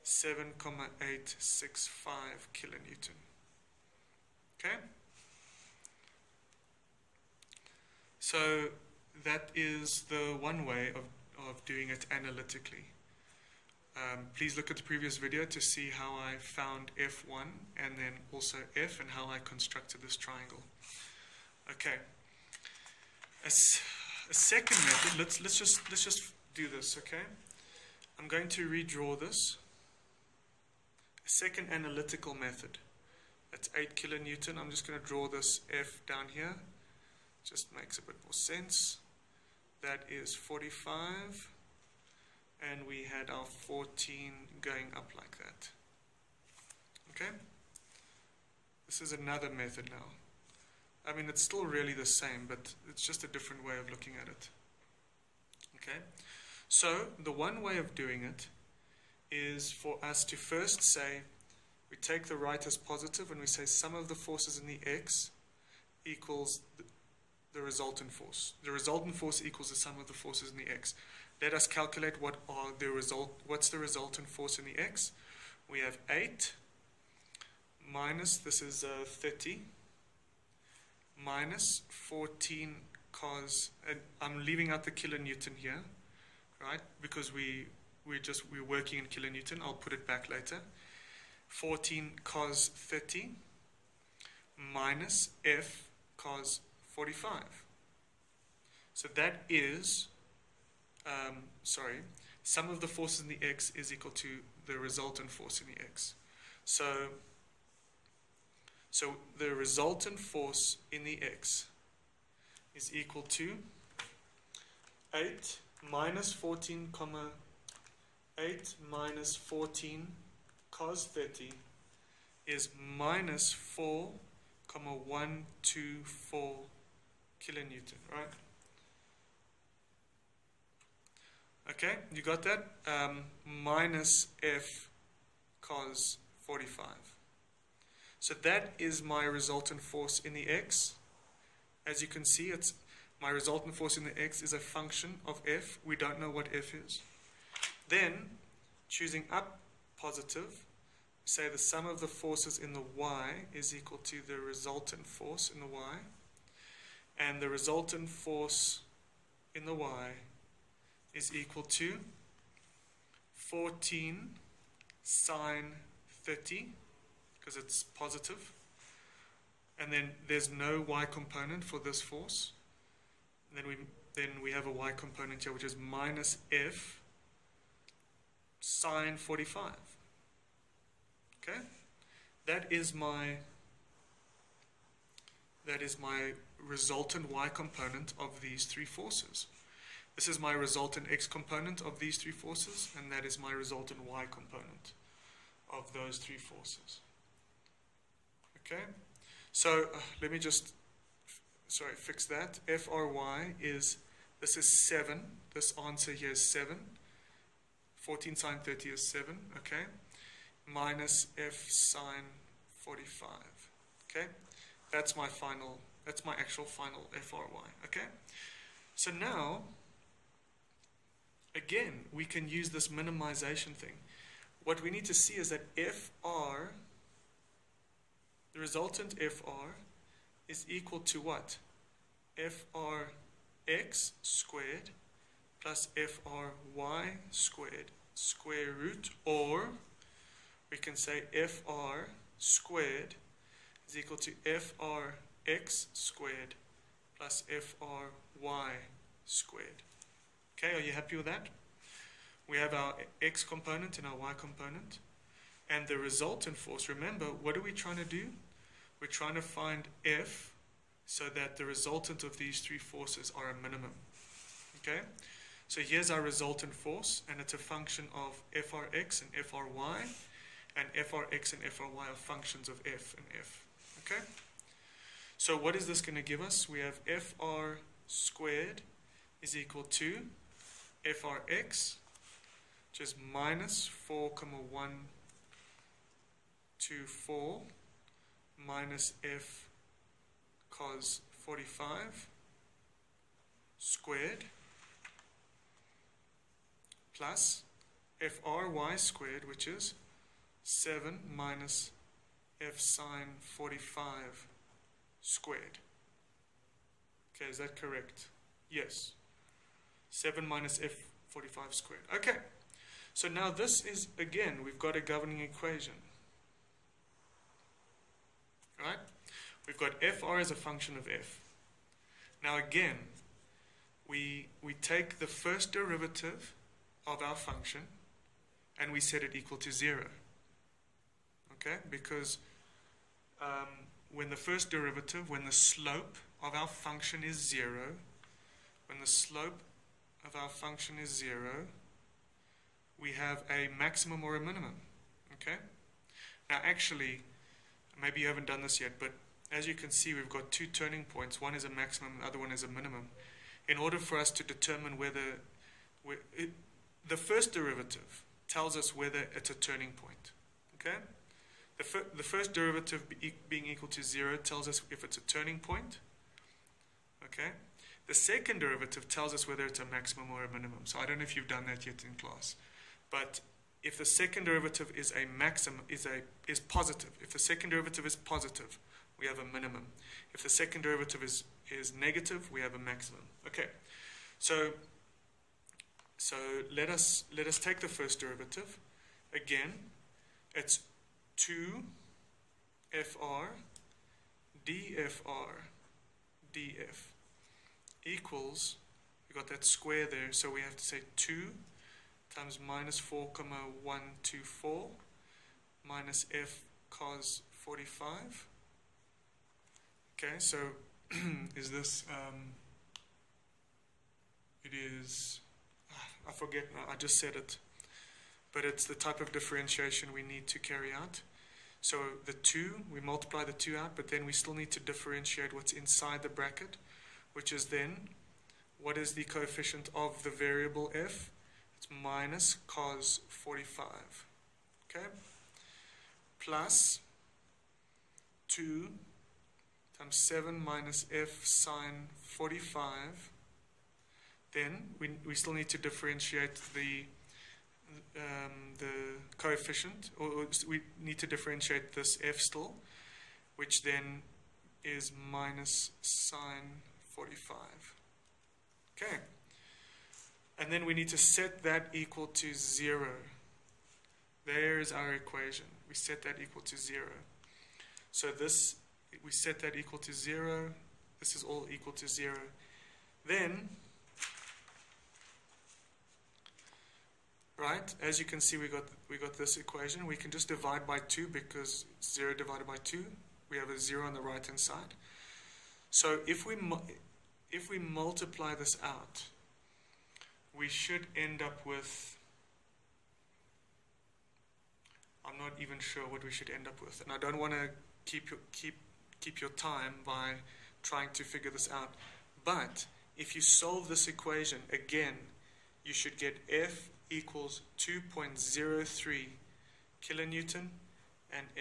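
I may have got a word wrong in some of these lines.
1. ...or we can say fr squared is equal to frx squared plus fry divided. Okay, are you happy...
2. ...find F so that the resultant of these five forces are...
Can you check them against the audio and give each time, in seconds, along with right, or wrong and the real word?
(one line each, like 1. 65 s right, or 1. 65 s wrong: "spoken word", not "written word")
1. 239 s wrong: "squared", not "divided"
2. 259 s wrong: "three", not "five".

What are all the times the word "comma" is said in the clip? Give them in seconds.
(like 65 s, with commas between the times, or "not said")
116 s, 124 s, 403 s.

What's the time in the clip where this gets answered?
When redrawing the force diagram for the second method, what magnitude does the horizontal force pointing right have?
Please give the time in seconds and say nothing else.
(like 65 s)
33 s.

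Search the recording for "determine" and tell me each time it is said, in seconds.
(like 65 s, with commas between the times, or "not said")
354 s.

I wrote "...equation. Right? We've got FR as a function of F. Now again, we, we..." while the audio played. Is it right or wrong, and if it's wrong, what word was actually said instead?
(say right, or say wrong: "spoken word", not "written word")
right.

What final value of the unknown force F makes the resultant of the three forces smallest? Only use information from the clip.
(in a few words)
2.03 kilonewton.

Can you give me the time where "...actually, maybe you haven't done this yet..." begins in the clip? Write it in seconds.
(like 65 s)
346 s.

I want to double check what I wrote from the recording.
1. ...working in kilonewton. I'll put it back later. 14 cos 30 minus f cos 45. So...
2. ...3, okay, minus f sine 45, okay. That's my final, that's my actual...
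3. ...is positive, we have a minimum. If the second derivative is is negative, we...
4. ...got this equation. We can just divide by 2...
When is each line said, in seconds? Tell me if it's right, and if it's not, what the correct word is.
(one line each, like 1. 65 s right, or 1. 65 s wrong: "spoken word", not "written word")
1. 88 s right
2. 209 s wrong: "7", not "3"
3. 378 s right
4. 479 s right.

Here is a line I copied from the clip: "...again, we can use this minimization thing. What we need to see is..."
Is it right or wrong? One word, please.
right.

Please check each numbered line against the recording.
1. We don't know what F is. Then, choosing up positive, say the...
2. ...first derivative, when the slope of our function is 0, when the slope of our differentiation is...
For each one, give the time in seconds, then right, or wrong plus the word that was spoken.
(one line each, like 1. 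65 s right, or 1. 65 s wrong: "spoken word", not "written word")
1. 145 s right
2. 334 s wrong: "function", not "differentiation".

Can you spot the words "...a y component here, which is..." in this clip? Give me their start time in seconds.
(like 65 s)
174 s.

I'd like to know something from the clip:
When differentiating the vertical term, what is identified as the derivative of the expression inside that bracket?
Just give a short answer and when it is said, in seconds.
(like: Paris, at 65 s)
minus sine 45, at 455 s.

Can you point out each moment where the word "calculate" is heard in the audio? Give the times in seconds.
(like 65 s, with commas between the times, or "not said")
71 s.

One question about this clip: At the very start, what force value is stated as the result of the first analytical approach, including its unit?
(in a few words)
7,865 kilonewton.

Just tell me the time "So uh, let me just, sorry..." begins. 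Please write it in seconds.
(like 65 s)
199 s.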